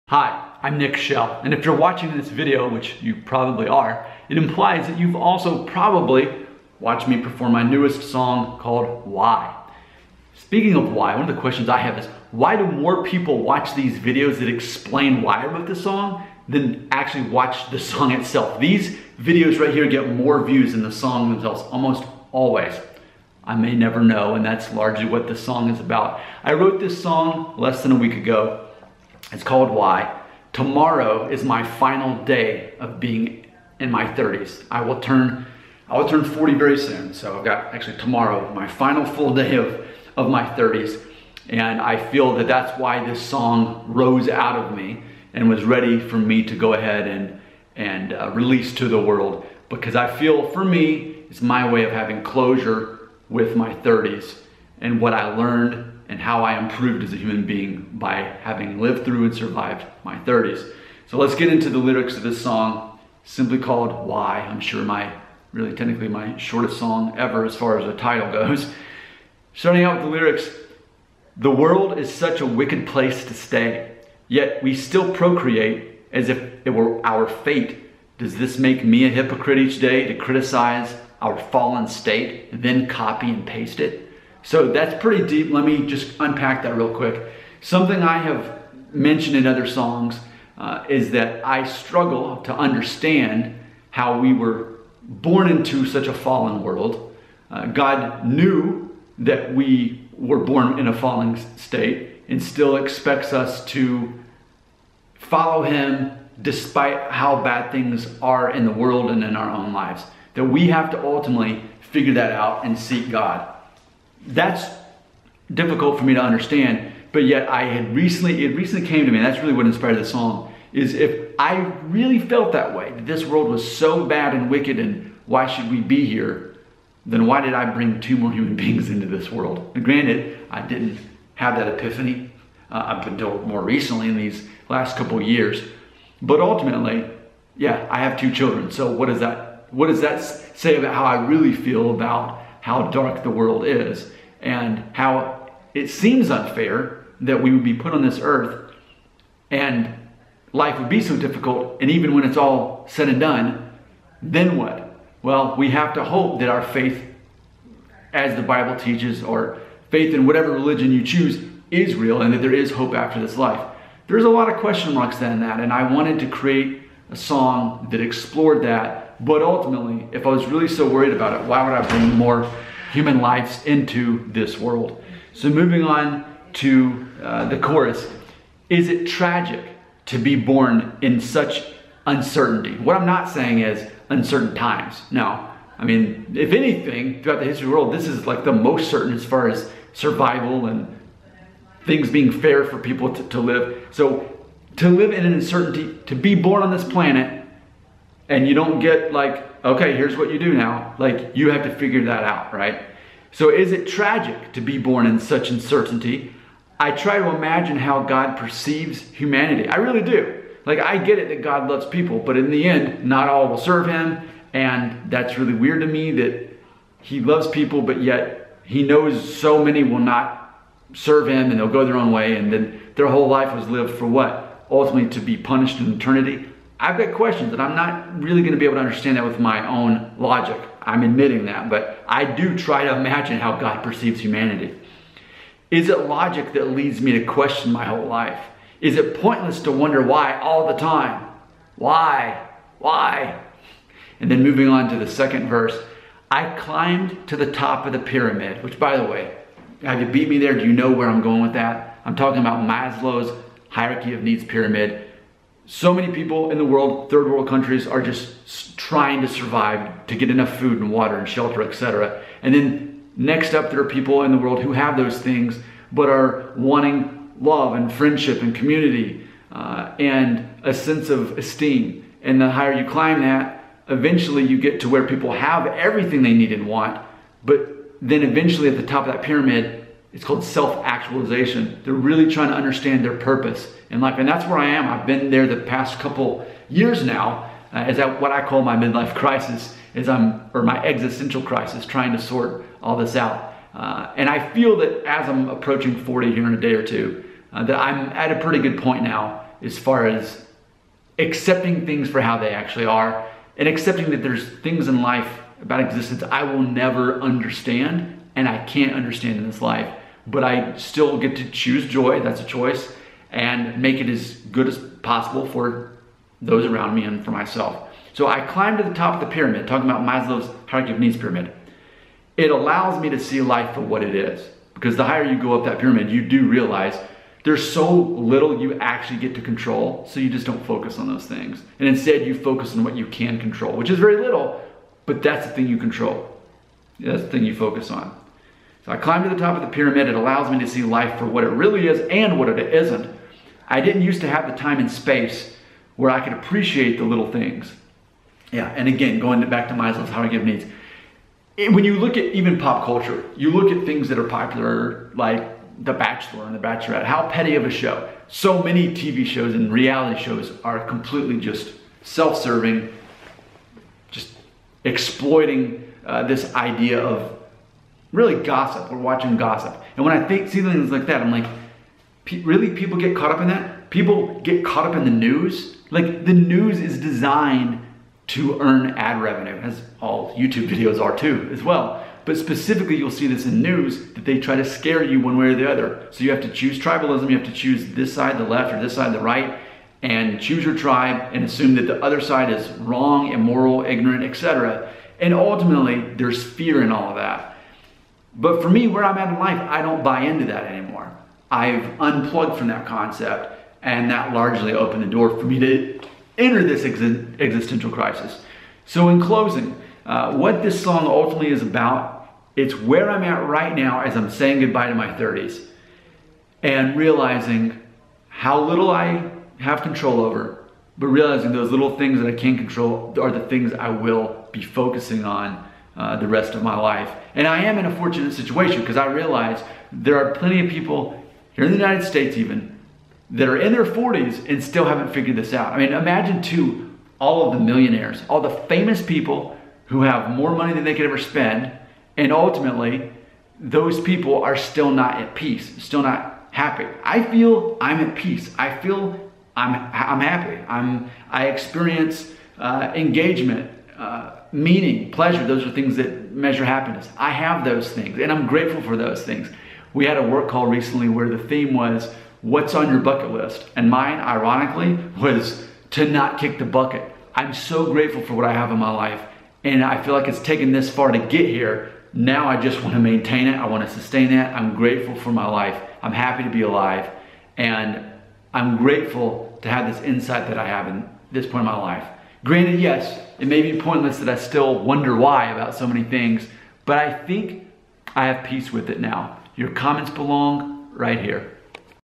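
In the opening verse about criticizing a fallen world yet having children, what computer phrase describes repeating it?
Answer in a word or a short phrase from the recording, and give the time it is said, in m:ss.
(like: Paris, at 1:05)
copy and paste, at 1:22.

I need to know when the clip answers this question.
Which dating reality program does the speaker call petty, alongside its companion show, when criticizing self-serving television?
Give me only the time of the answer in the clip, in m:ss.
5:55.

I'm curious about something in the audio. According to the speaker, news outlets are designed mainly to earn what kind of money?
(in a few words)
ad revenue.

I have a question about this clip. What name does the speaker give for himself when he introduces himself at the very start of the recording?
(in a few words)
Nick Shell.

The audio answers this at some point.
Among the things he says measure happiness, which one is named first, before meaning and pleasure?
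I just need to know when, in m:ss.
7:32.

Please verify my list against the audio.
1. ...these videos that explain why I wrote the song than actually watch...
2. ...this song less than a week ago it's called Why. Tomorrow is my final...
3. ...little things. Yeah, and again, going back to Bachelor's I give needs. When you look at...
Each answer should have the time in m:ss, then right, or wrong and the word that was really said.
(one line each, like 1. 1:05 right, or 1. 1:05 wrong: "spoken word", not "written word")
1. 0:13 right
2. 0:26 right
3. 5:47 wrong: "Maslow", not "Bachelor".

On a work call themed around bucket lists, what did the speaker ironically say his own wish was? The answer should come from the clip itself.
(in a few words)
to not kick the bucket.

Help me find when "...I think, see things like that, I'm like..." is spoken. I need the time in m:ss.
6:10.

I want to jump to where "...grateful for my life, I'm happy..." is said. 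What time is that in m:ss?
7:54.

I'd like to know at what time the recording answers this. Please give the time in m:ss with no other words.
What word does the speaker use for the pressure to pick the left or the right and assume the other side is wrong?
6:26.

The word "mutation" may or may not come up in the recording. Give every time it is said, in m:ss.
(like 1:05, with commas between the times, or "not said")
not said.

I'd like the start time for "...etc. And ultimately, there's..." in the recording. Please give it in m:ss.
6:34.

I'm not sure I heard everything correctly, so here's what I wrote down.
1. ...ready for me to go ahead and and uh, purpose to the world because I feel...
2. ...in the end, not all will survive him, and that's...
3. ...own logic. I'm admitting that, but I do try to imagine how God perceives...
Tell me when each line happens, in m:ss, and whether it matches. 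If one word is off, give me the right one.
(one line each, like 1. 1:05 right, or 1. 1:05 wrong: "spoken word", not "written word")
1. 0:45 wrong: "release", not "purpose"
2. 3:32 wrong: "serve", not "survive"
3. 3:49 right.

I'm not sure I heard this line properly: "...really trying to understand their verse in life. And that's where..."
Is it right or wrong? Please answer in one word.
wrong.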